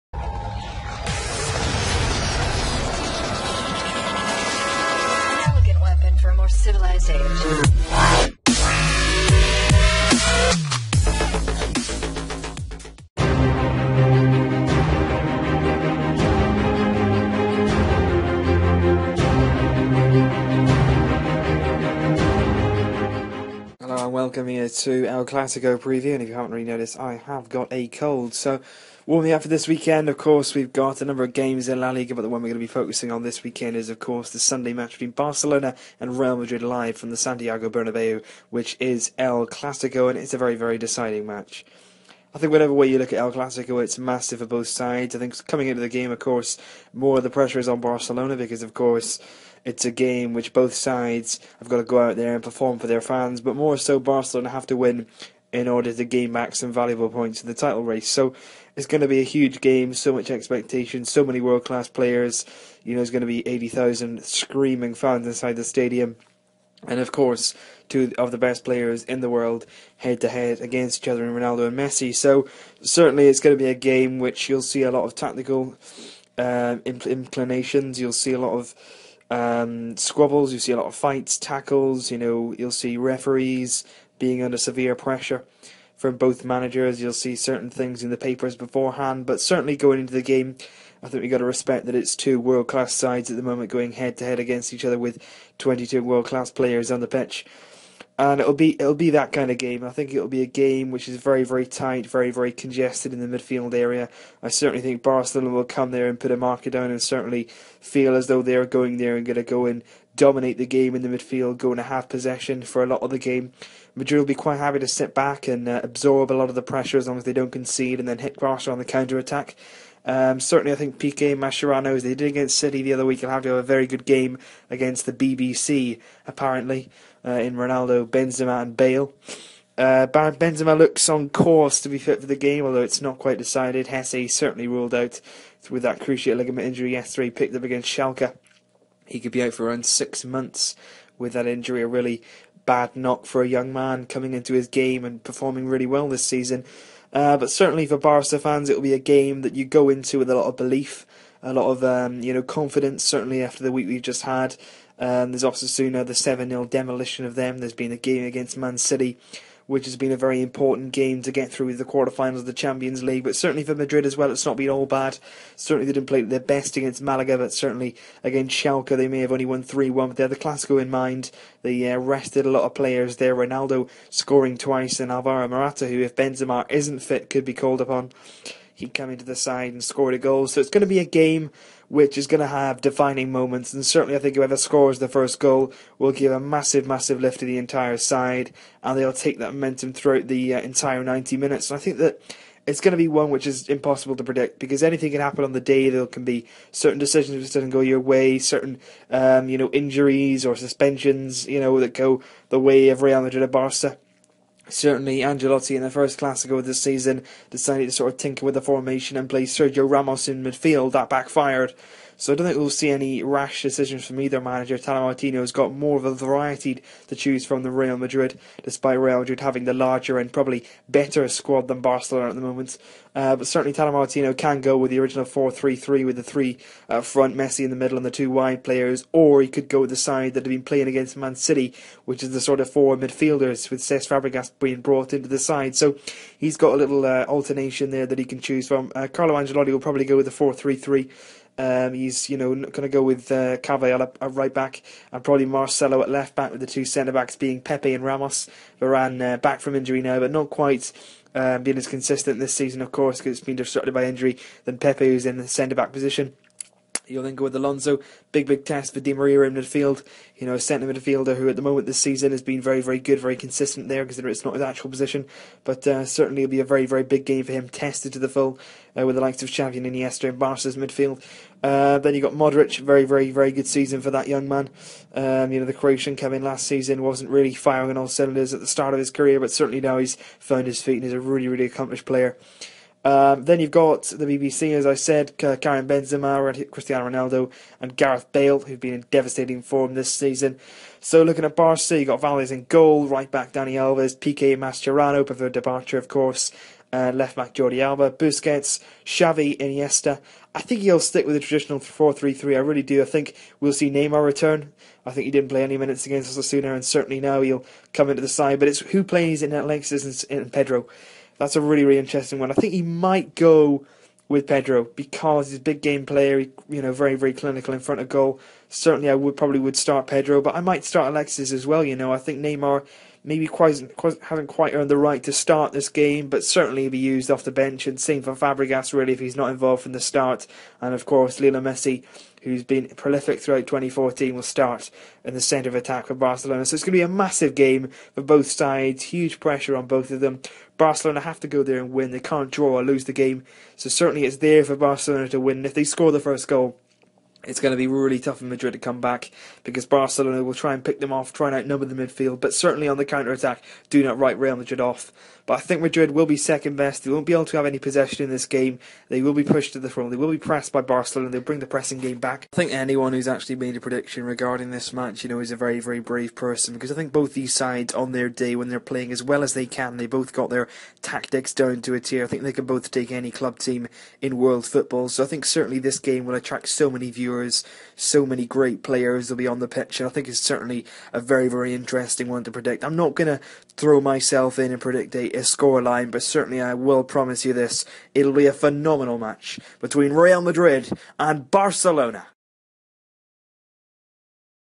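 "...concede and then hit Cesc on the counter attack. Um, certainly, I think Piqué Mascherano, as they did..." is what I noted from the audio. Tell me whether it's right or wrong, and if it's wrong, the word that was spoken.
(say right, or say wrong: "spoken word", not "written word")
wrong: "Barca", not "Cesc".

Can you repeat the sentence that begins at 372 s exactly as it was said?
I think they can both take any club team in world football.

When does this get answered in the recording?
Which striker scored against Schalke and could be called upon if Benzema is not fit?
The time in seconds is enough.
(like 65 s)
175 s.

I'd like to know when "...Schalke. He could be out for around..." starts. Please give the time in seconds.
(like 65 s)
137 s.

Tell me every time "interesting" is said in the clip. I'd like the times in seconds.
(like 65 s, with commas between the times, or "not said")
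311 s, 381 s.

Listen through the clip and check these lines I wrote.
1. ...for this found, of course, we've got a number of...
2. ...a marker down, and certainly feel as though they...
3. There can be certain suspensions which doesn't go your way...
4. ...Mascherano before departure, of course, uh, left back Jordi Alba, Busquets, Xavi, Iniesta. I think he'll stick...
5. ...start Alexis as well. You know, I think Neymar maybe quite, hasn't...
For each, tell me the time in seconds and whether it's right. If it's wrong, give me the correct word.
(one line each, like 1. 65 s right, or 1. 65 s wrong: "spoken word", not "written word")
1. 29 s wrong: "weekend", not "found"
2. 106 s right
3. 195 s wrong: "decisions", not "suspensions"
4. 294 s right
5. 320 s right.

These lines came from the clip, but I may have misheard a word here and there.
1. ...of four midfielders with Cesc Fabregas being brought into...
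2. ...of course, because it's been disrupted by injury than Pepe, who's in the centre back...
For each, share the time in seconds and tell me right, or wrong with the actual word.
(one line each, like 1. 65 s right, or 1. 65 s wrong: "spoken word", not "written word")
1. 232 s right
2. 252 s right.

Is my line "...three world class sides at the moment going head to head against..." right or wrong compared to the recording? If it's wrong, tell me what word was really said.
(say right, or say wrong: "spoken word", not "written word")
wrong: "two", not "three".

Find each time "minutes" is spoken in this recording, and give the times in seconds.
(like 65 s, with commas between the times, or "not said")
191 s, 305 s.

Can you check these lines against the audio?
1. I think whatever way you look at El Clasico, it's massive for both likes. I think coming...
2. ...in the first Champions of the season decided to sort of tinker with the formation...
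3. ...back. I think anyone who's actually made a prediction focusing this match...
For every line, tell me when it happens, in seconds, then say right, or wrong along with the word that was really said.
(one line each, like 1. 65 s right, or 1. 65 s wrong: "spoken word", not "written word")
1. 42 s wrong: "sides", not "likes"
2. 205 s wrong: "Classico", not "Champions"
3. 362 s wrong: "regarding", not "focusing".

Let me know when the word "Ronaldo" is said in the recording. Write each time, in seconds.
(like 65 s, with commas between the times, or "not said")
71 s, 127 s, 173 s, 287 s.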